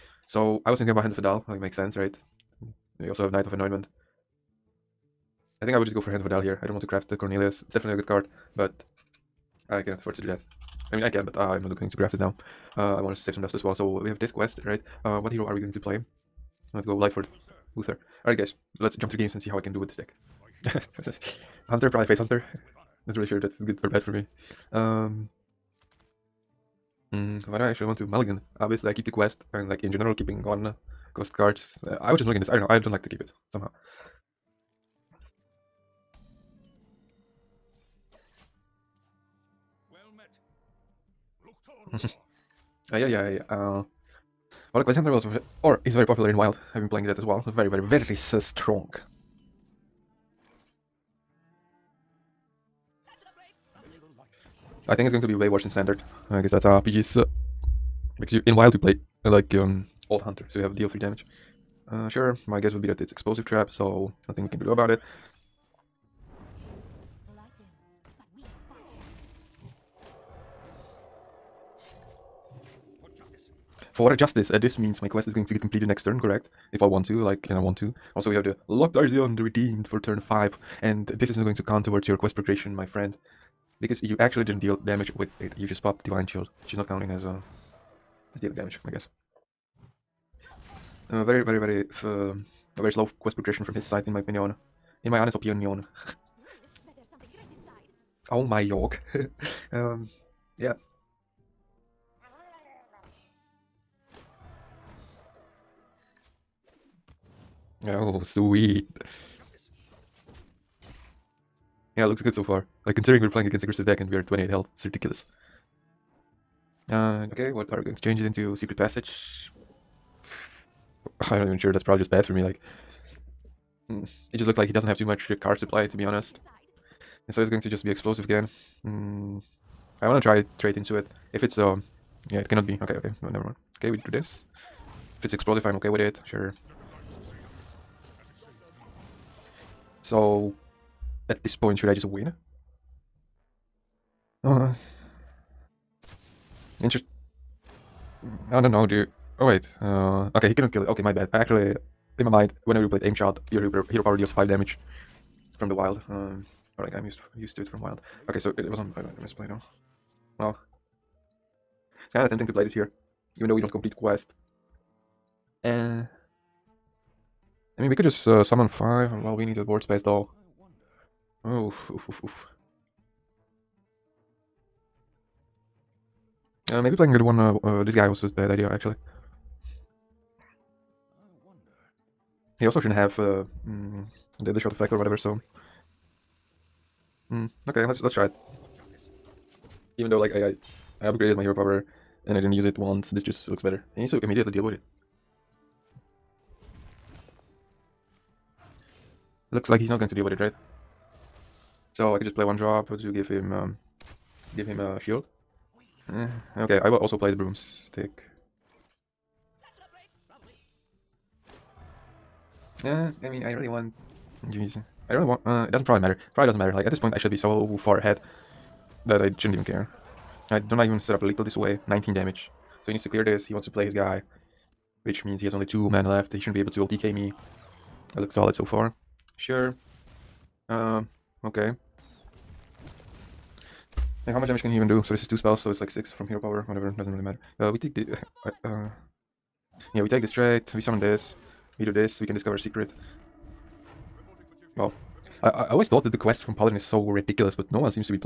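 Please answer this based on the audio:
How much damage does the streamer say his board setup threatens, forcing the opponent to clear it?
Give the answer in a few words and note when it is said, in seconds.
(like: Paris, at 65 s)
19, at 221 s.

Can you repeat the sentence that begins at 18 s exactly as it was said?
Alright guys, let's jump to the games and see how I can do with this deck.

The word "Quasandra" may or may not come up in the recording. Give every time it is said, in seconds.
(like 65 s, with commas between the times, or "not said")
44 s.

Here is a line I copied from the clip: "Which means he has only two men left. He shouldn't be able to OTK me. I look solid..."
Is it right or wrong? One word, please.
right.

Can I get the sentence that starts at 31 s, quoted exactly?
Uh, I would just mulligan this.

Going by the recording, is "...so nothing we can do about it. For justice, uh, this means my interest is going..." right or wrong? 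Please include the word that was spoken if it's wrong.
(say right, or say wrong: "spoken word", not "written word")
wrong: "quest", not "interest".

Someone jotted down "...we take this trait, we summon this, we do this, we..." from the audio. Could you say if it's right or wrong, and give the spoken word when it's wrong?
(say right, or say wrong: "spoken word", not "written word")
right.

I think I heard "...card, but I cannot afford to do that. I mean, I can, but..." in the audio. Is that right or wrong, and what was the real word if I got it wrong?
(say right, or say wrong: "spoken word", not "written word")
right.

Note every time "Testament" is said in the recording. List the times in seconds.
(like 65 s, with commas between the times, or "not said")
not said.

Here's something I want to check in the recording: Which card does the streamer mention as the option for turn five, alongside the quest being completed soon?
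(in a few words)
Lothraxion, the Redeemed.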